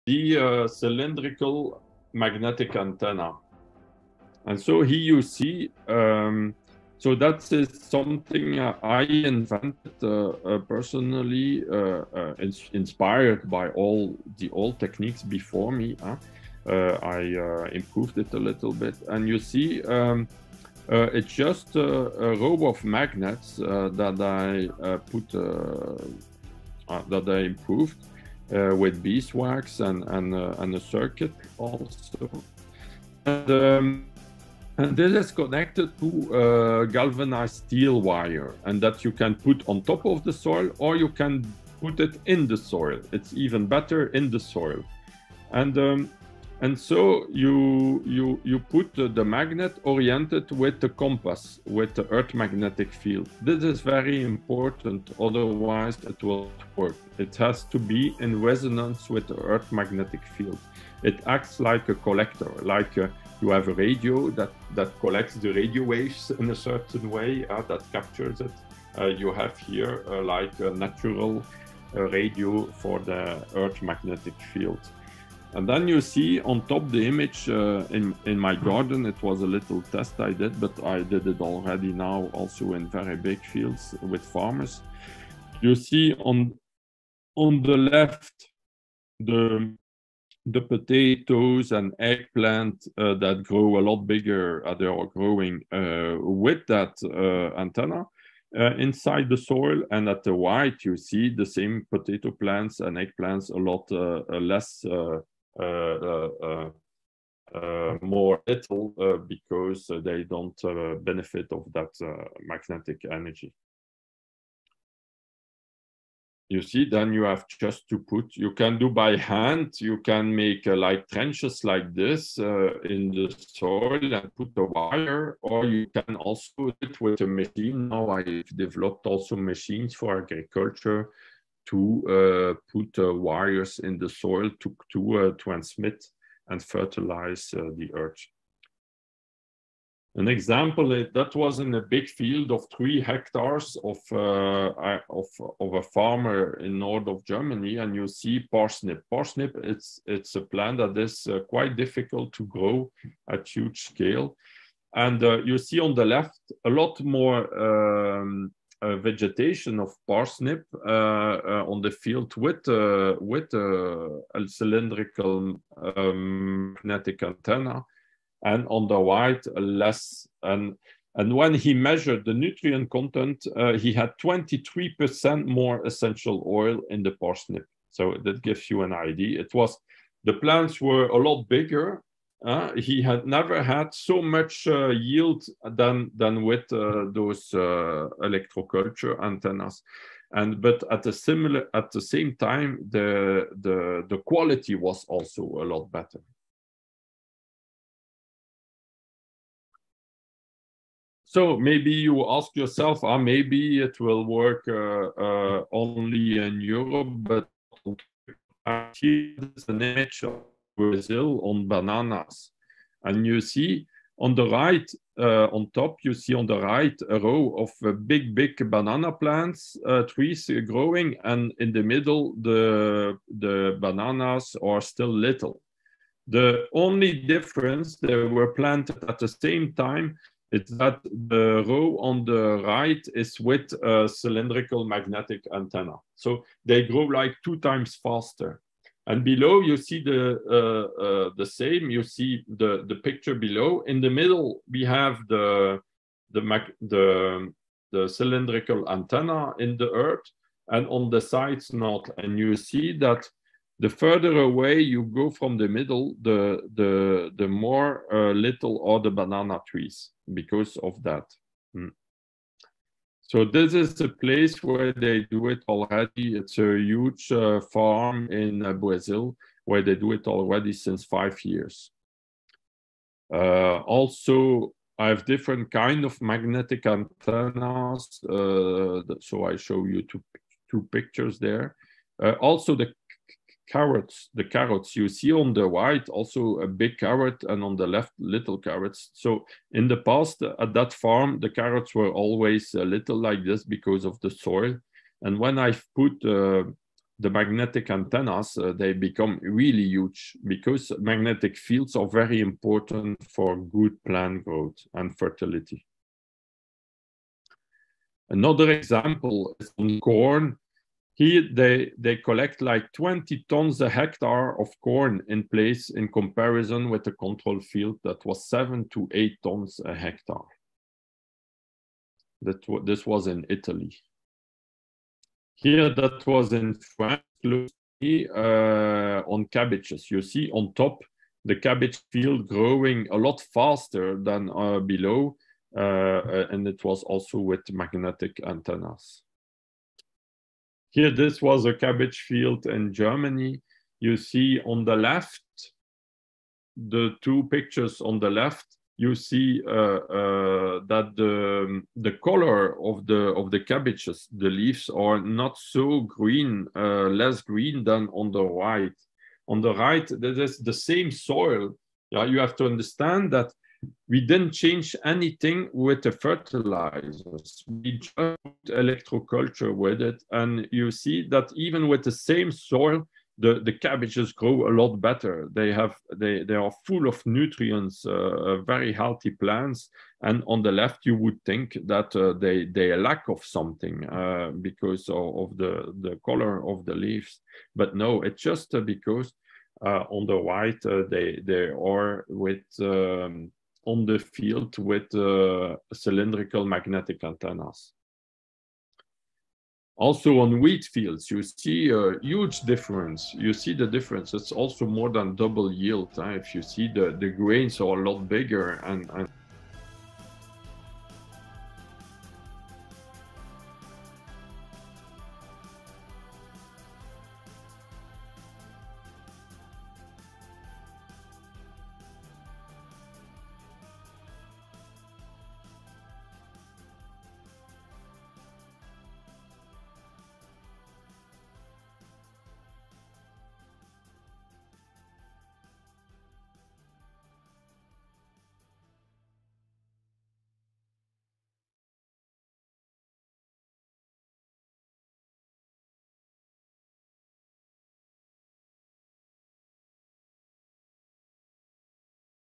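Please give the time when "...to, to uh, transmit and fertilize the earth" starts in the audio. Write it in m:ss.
2:14.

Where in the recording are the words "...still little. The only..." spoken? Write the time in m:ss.
3:44.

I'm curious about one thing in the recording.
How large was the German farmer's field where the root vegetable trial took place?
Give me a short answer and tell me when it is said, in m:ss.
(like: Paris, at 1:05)
3 hectares, at 2:22.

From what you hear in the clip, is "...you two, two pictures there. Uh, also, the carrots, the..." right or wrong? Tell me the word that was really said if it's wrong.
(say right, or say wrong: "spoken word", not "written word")
right.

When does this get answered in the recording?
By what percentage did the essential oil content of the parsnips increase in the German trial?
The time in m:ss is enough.
2:54.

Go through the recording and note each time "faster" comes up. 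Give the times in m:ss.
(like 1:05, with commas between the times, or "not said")
3:57, 5:33.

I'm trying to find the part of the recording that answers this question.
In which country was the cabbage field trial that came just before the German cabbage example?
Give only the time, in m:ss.
5:26.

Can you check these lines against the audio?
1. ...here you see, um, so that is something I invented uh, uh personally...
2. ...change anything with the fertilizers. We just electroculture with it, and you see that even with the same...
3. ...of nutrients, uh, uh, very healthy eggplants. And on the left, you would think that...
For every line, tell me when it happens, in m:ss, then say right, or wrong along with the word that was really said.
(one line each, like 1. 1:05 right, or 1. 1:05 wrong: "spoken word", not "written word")
1. 0:04 right
2. 6:04 right
3. 6:17 wrong: "plants", not "eggplants".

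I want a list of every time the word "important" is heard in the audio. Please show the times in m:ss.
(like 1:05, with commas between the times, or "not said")
0:54, 5:02.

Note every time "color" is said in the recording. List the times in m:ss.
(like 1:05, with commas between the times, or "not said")
5:52, 6:26.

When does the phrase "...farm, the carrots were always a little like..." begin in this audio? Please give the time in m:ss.
4:50.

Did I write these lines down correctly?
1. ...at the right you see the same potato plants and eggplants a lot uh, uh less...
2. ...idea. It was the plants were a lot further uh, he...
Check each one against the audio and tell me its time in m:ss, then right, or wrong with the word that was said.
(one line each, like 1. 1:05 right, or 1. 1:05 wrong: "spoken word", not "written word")
1. 1:40 right
2. 2:58 wrong: "bigger", not "further".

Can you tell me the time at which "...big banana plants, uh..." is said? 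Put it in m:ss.
3:38.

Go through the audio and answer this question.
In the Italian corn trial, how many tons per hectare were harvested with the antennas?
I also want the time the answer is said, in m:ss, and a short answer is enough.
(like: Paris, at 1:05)
20 tons, at 5:12.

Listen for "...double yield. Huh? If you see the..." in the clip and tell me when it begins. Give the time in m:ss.
6:45.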